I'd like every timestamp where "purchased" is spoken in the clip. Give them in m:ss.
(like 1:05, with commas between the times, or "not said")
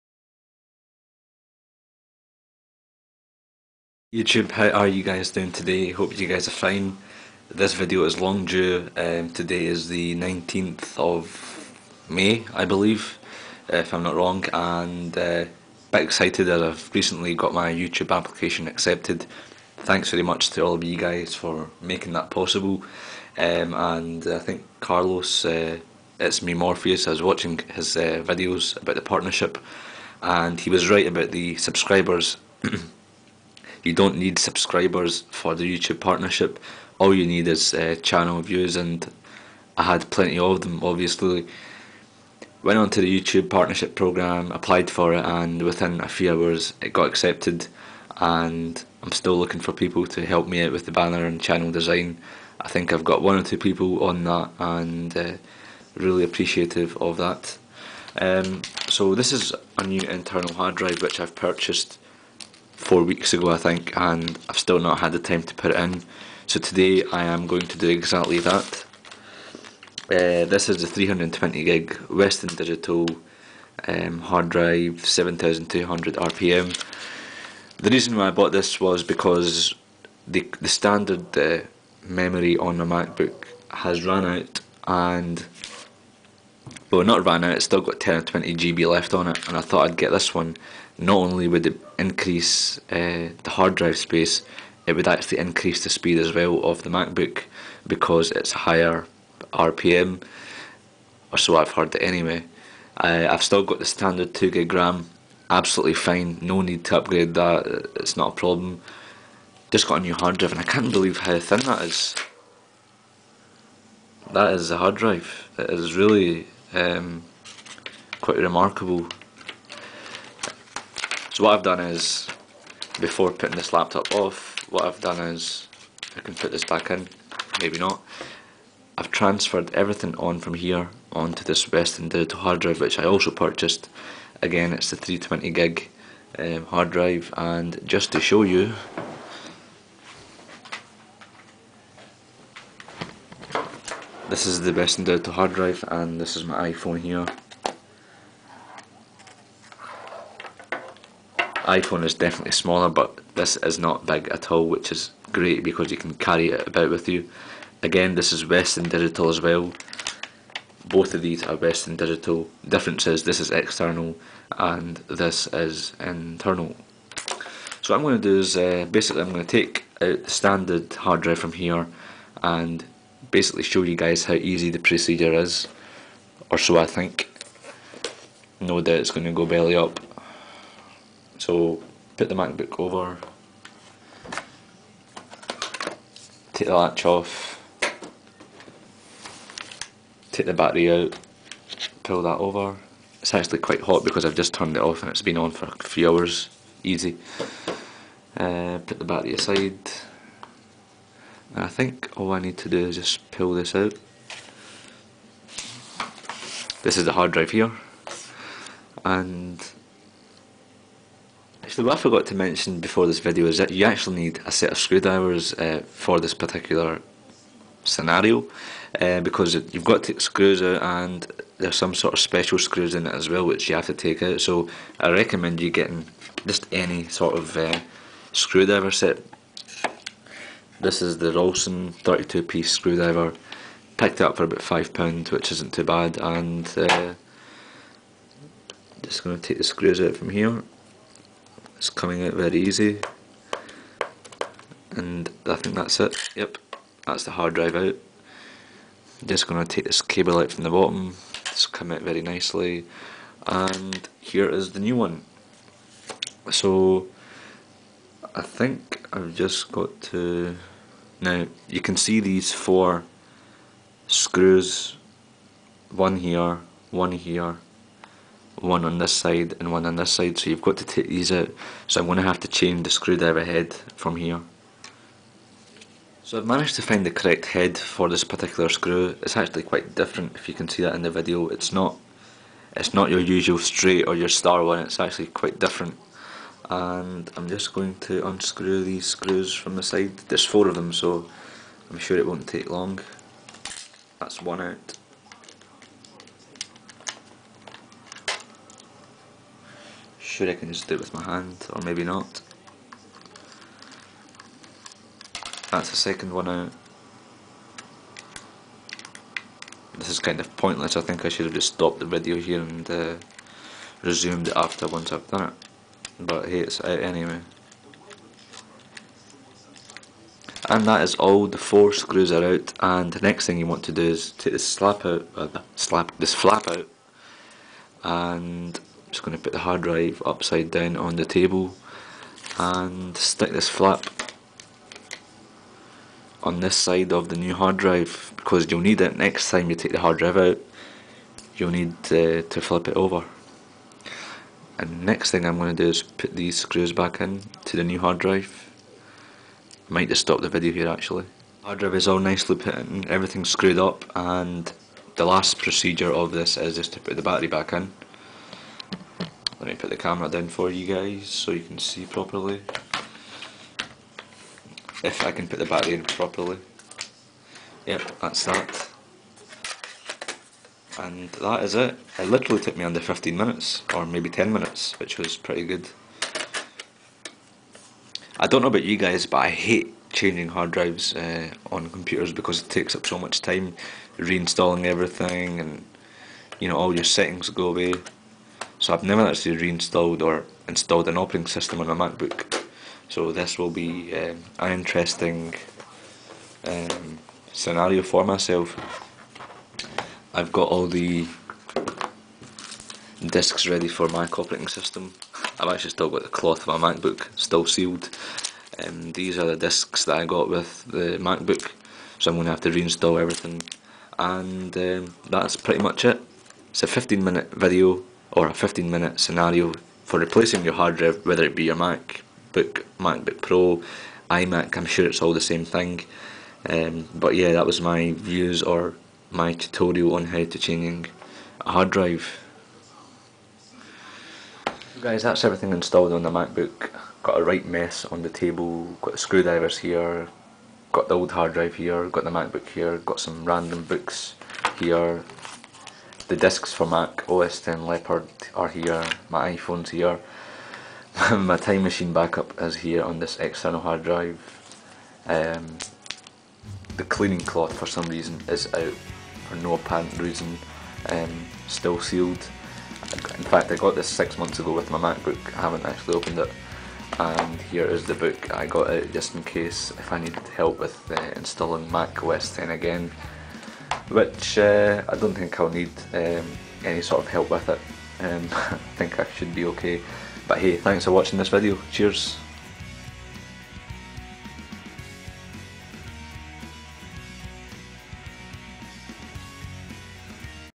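1:01, 2:13.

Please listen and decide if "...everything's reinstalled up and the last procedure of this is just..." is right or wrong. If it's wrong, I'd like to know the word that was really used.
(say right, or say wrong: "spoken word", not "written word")
wrong: "screwed", not "reinstalled".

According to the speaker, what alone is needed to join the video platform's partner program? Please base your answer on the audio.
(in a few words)
Channel views.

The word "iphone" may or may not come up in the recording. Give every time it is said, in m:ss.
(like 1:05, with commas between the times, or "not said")
2:26, 2:31, 7:29.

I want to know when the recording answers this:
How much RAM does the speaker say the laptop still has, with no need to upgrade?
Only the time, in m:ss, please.
1:44.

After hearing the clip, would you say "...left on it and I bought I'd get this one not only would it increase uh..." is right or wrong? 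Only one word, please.
wrong.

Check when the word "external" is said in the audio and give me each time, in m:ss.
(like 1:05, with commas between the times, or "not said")
2:43, 7:33.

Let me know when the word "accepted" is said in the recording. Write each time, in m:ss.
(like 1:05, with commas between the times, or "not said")
0:18, 0:47.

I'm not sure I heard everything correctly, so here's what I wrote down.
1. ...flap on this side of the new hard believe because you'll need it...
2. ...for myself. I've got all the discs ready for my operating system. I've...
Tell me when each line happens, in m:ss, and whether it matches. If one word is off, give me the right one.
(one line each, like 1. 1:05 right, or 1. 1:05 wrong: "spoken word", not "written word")
1. 5:33 wrong: "drive", not "believe"
2. 6:38 right.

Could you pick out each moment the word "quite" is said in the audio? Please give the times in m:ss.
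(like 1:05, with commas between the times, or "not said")
1:58, 3:13, 4:39, 4:45.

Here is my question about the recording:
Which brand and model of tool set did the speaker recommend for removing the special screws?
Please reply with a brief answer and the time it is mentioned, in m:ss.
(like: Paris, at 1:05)
Rolson 32 piece, at 3:51.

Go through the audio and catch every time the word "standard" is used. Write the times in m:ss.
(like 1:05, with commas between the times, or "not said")
1:20, 1:43, 2:50.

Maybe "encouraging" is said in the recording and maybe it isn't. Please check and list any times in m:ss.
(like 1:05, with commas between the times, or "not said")
not said.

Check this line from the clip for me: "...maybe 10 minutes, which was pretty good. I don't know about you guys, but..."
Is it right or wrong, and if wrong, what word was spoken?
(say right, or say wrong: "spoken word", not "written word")
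right.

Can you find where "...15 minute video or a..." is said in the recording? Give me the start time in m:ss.
6:56.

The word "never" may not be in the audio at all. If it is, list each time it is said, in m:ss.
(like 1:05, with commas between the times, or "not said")
6:29.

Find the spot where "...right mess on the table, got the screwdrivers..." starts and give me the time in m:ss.
7:17.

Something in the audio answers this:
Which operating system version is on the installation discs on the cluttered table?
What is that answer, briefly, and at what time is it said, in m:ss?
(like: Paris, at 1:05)
Mac OS X Leopard, at 7:26.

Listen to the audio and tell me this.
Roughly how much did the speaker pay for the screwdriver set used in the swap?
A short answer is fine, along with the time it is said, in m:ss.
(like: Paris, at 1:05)
£5, at 3:54.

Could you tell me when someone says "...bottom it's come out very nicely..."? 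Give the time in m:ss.
4:10.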